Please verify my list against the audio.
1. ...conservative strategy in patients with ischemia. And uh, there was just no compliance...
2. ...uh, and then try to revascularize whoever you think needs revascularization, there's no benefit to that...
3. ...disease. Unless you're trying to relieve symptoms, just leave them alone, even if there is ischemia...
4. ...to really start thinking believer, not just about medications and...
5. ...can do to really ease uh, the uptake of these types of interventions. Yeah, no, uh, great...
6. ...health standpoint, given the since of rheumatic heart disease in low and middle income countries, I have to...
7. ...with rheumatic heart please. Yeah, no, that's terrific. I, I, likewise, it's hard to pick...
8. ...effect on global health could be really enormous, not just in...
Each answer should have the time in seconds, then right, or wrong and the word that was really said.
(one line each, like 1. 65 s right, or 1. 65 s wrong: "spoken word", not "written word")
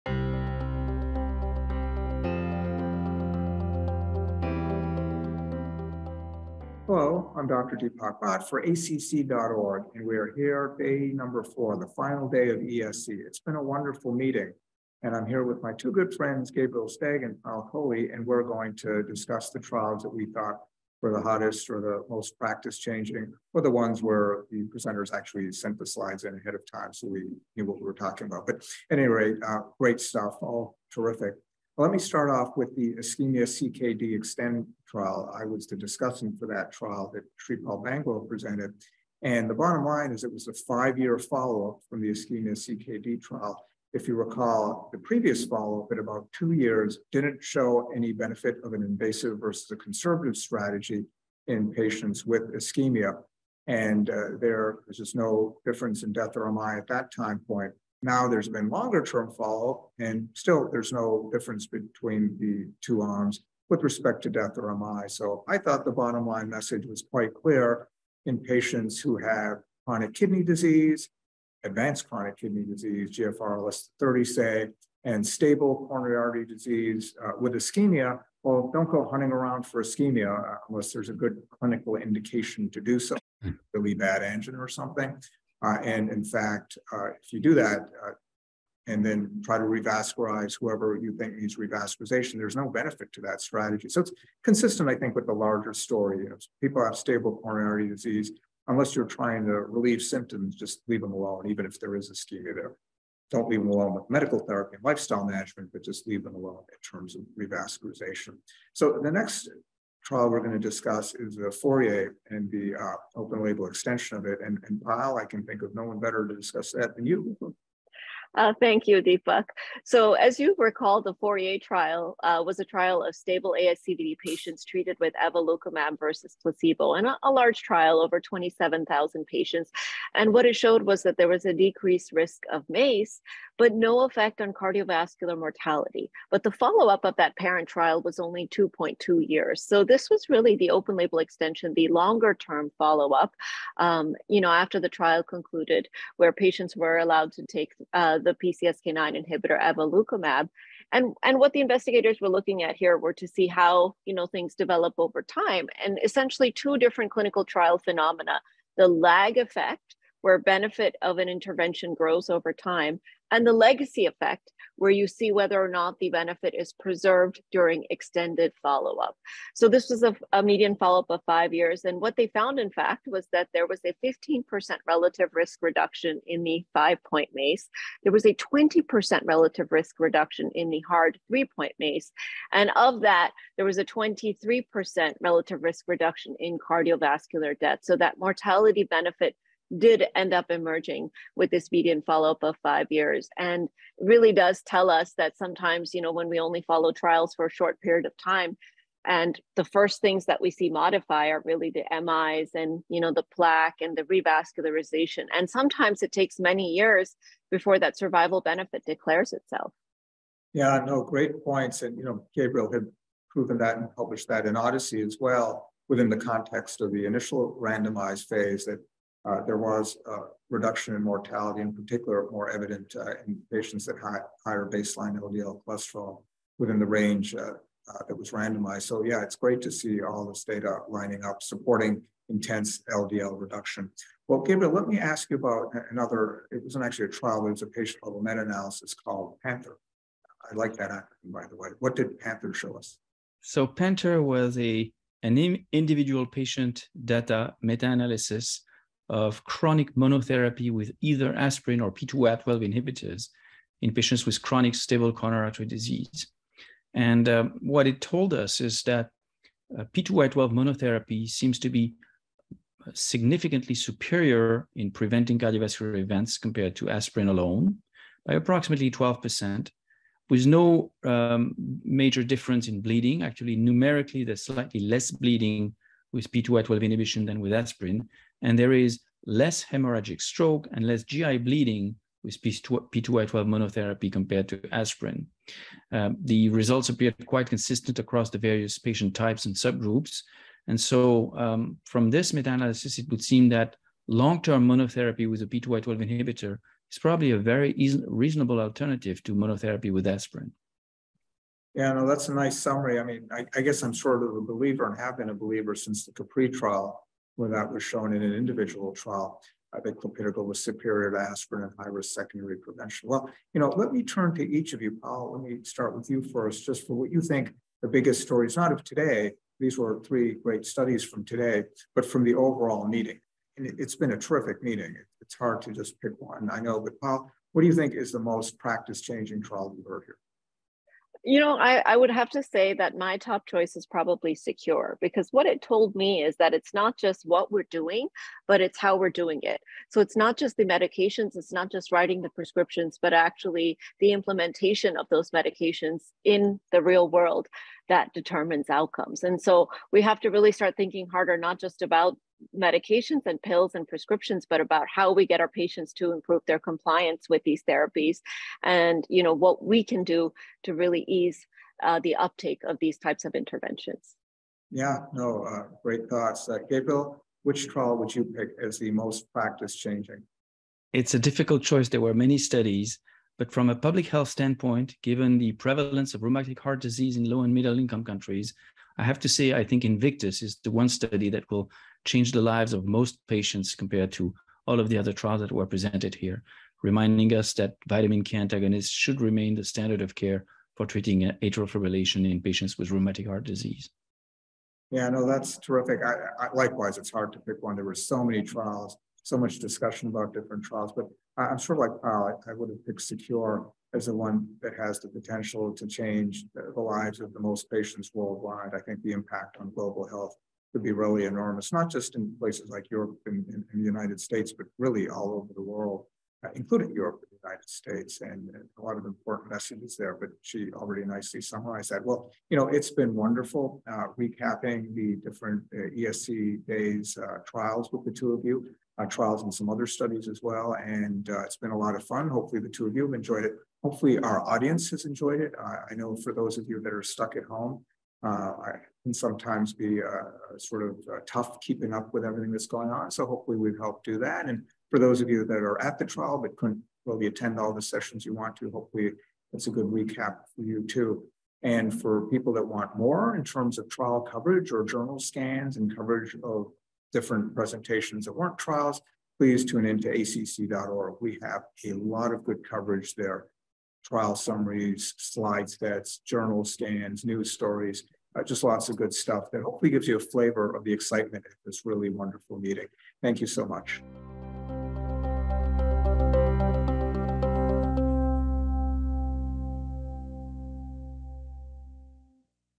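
1. 49 s wrong: "difference", not "compliance"
2. 88 s right
3. 97 s right
4. 350 s wrong: "harder", not "believer"
5. 359 s right
6. 374 s wrong: "prevalence", not "since"
7. 392 s wrong: "disease", not "please"
8. 409 s wrong: "impact", not "effect".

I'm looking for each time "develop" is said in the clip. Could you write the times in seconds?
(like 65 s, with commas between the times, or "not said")
154 s.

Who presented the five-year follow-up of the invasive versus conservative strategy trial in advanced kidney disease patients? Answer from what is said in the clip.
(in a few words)
Paul Bangalore.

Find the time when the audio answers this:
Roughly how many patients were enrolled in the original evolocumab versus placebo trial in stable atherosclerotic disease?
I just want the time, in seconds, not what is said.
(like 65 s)
128 s.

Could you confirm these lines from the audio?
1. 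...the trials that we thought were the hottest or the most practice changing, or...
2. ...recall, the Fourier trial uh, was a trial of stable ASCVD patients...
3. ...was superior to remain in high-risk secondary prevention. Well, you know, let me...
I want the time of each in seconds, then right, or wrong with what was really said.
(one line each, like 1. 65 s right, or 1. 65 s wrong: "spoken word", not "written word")
1. 19 s right
2. 120 s right
3. 310 s wrong: "aspirin", not "remain".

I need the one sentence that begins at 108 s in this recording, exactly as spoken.
So the next trial we're going to discuss is the Fourier and the uh, open label extension of it.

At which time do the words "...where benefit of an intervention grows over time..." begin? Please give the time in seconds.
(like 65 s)
160 s.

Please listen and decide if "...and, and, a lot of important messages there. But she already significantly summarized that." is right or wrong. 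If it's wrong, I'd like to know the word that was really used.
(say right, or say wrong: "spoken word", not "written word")
wrong: "nicely", not "significantly".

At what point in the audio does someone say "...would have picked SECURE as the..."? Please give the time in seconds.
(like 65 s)
402 s.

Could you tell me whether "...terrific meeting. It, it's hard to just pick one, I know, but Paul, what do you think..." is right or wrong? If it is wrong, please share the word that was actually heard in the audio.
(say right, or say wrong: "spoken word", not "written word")
right.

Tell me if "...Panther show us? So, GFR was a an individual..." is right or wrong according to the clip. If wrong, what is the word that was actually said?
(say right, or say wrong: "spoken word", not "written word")
wrong: "Panther", not "GFR".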